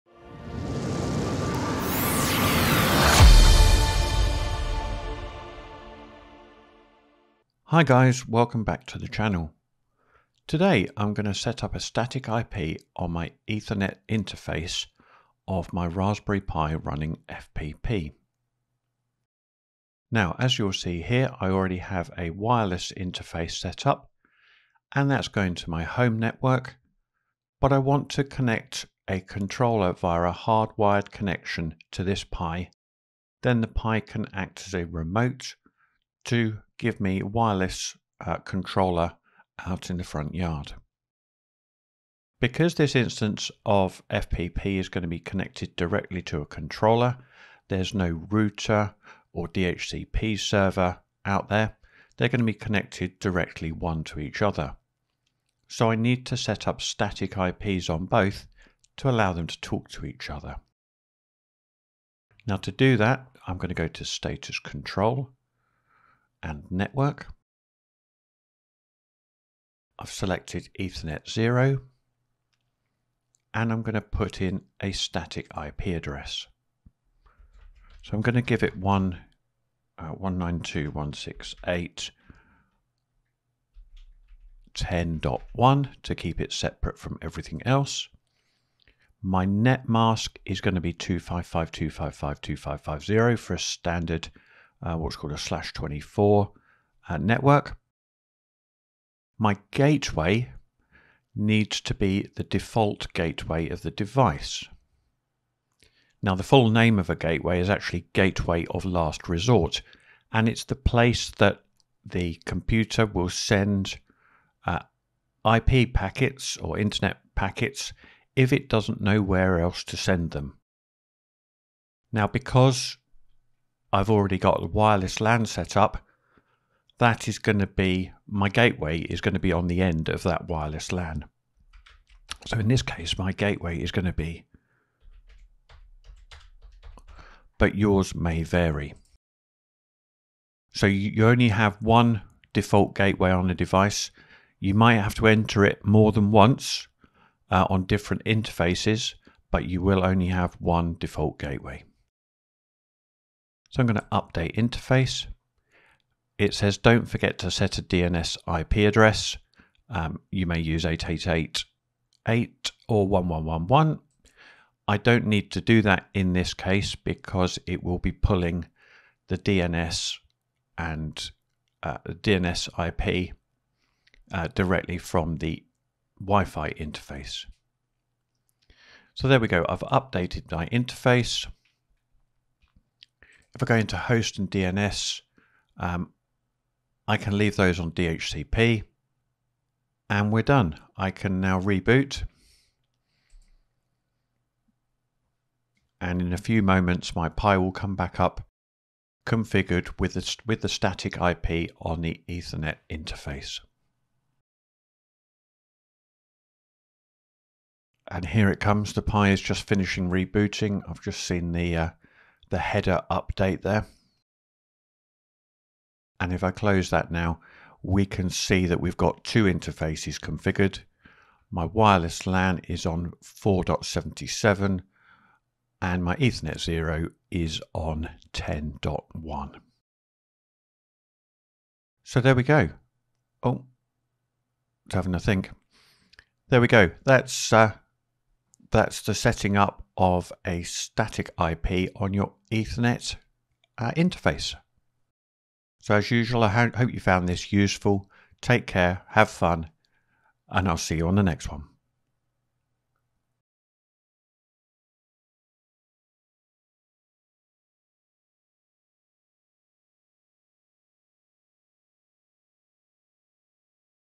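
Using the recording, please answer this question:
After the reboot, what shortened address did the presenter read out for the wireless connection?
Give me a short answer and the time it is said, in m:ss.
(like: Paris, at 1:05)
4.77, at 3:43.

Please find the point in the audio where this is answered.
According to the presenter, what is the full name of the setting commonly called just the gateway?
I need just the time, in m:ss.
1:48.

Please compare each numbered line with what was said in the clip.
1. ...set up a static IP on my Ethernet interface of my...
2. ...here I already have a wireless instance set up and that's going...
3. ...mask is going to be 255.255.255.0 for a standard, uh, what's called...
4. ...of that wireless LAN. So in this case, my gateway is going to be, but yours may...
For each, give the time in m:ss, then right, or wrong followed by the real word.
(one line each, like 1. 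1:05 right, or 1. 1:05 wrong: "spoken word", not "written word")
1. 0:11 right
2. 0:21 wrong: "interface", not "instance"
3. 1:29 right
4. 2:10 right.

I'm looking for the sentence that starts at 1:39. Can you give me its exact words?
My gateway needs to be the default gateway of the device.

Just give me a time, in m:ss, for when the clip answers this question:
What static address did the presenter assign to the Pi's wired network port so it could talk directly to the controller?
1:20.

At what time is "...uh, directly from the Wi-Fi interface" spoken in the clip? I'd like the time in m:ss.
2:54.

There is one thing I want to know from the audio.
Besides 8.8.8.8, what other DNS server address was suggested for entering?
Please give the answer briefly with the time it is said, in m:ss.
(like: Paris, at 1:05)
1.1.1.1, at 2:43.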